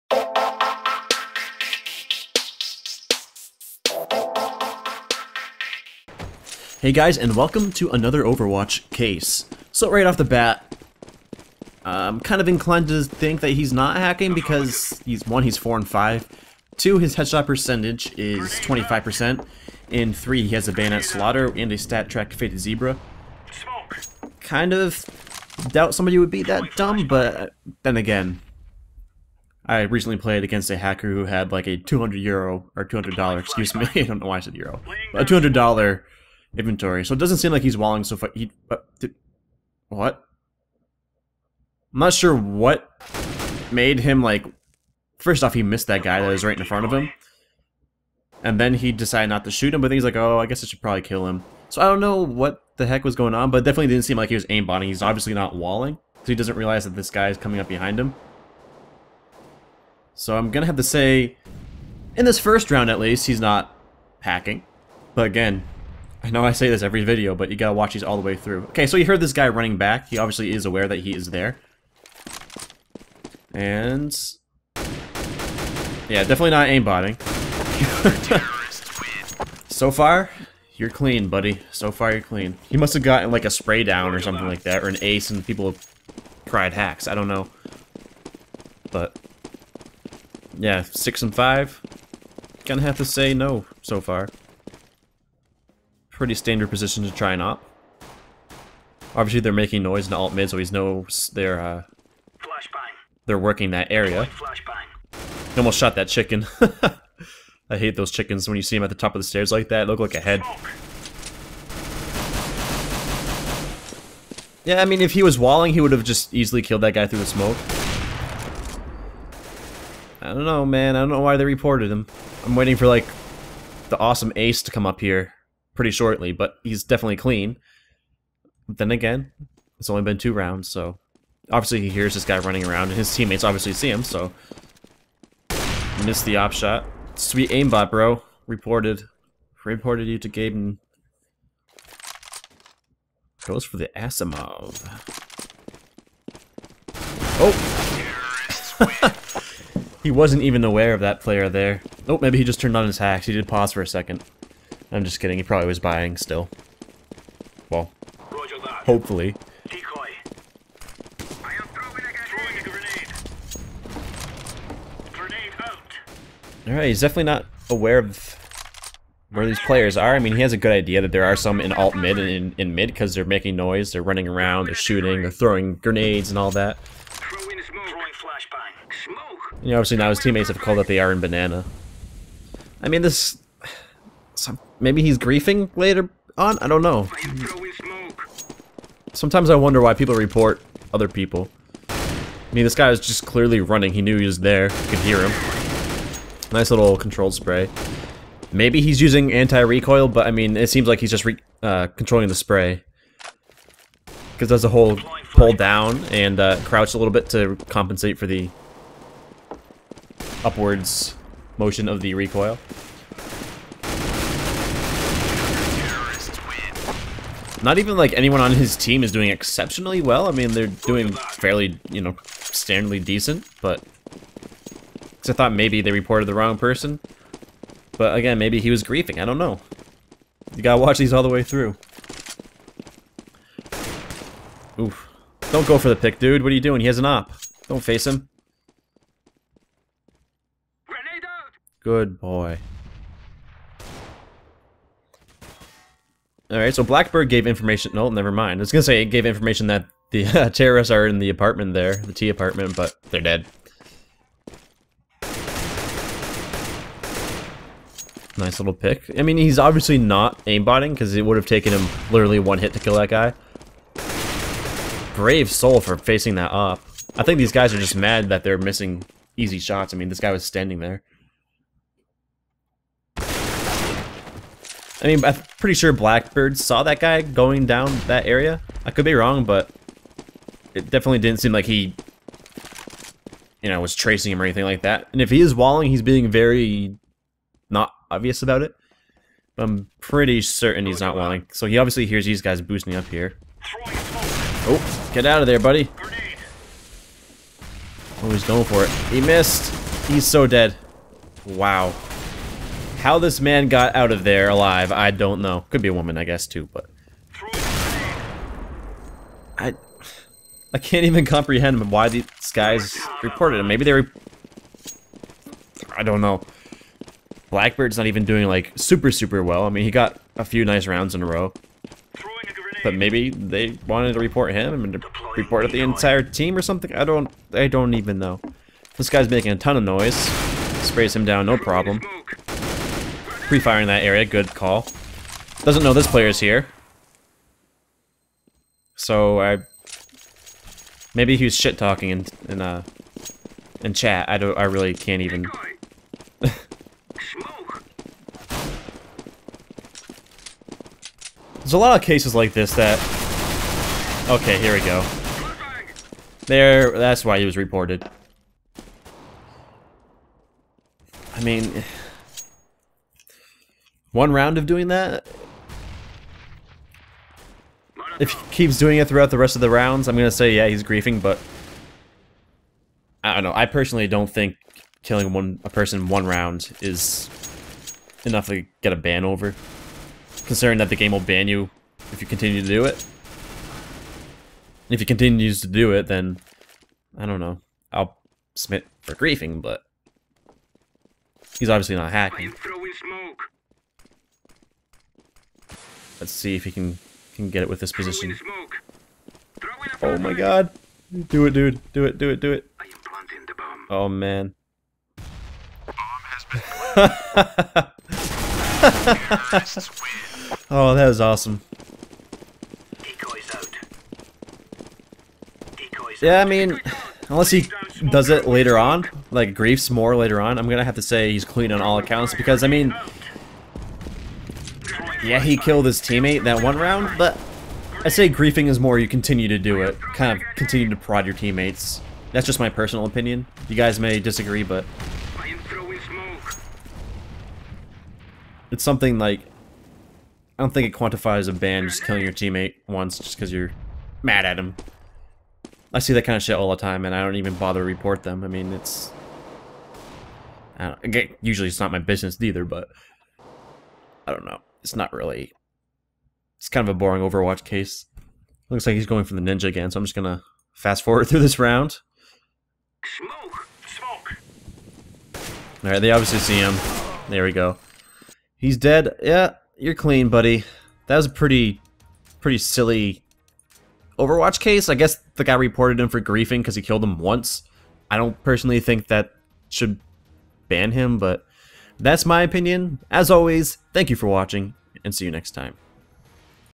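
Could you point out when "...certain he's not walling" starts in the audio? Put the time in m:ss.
4:50.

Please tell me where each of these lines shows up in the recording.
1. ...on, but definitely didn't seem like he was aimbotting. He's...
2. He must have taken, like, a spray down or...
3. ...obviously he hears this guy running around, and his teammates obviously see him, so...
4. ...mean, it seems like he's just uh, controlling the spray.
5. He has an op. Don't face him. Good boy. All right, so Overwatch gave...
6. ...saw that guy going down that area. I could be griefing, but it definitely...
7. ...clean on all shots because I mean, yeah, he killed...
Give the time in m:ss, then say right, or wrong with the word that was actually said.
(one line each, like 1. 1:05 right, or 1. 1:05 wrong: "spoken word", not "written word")
1. 0:53 right
2. 1:22 wrong: "gotten", not "taken"
3. 2:11 right
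4. 3:20 right
5. 3:56 wrong: "Blackbird", not "Overwatch"
6. 4:36 wrong: "wrong", not "griefing"
7. 7:01 wrong: "accounts", not "shots".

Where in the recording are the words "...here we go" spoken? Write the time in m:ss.
5:54.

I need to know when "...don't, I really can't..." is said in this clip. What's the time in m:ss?
5:44.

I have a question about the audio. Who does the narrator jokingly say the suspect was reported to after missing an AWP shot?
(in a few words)
Gaben.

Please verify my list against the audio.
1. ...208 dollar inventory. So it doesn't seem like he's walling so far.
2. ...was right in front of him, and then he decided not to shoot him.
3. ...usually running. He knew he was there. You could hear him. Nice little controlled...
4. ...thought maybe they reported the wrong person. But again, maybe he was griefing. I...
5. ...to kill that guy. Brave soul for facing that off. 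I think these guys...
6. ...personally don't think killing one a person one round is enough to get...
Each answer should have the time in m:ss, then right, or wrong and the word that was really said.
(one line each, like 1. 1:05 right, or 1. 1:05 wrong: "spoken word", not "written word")
1. 0:35 wrong: "200", not "208"
2. 0:46 right
3. 3:13 wrong: "clearly", not "usually"
4. 3:45 right
5. 4:22 right
6. 6:13 right.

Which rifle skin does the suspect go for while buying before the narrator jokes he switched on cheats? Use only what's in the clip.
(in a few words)
Asimov.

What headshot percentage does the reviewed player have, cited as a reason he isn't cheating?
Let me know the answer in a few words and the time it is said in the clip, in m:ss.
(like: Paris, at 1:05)
25%, at 0:18.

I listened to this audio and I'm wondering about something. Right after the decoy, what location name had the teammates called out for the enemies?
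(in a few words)
iron banana.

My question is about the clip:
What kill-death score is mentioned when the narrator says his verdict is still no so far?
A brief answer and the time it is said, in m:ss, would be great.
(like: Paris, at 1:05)
6 and 5, at 1:30.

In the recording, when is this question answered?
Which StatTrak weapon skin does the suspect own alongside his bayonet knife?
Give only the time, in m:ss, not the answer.
0:22.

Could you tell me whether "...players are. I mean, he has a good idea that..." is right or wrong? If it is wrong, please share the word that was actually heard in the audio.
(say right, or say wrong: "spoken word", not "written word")
right.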